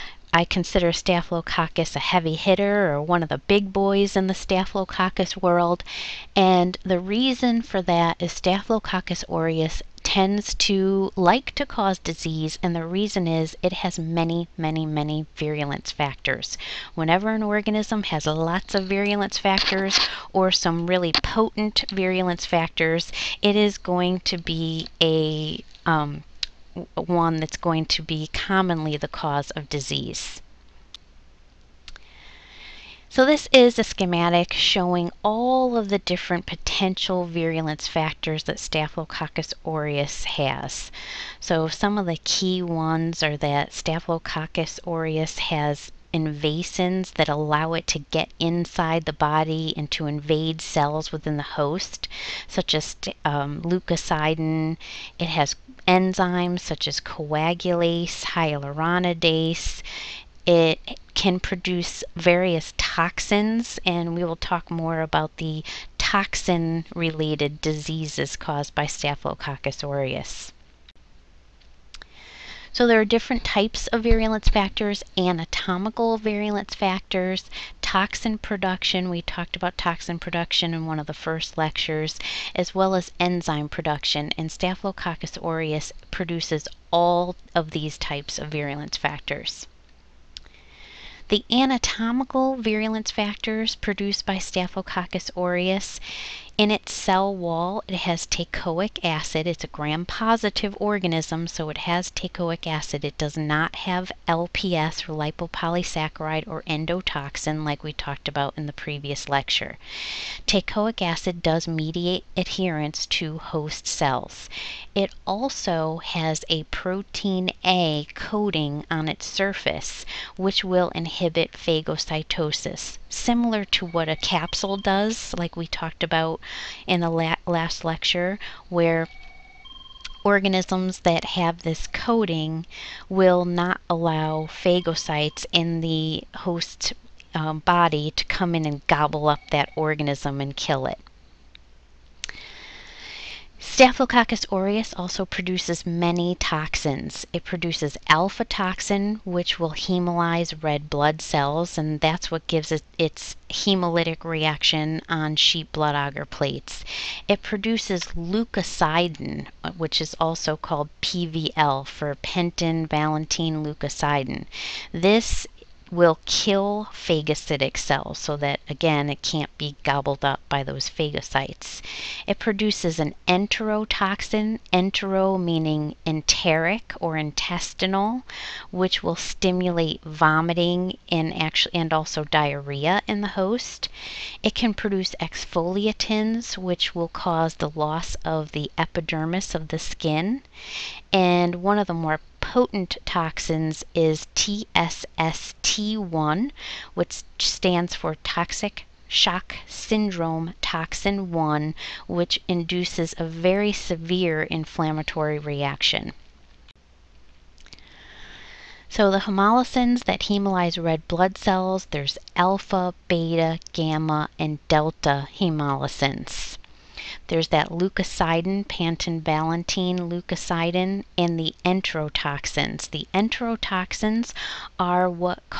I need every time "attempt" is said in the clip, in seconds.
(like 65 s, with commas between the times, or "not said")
not said.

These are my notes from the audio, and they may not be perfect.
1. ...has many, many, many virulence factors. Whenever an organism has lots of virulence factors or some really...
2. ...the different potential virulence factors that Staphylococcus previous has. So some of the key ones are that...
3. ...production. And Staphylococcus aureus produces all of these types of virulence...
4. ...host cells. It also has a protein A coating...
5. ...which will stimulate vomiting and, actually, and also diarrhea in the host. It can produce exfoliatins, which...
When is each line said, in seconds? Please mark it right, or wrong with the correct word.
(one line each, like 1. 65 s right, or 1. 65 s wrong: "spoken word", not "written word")
1. 13 s right
2. 35 s wrong: "aureus", not "previous"
3. 83 s right
4. 113 s right
5. 178 s right.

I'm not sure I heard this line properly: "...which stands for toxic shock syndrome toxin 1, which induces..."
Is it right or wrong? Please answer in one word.
right.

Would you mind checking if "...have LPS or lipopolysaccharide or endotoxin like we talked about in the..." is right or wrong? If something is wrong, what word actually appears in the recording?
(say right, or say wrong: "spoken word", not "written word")
right.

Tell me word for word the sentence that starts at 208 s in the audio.
So the hemolysins that hemolyze red blood cells, there's alpha, beta, gamma, and delta hemolysins.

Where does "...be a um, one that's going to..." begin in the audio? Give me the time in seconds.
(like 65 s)
24 s.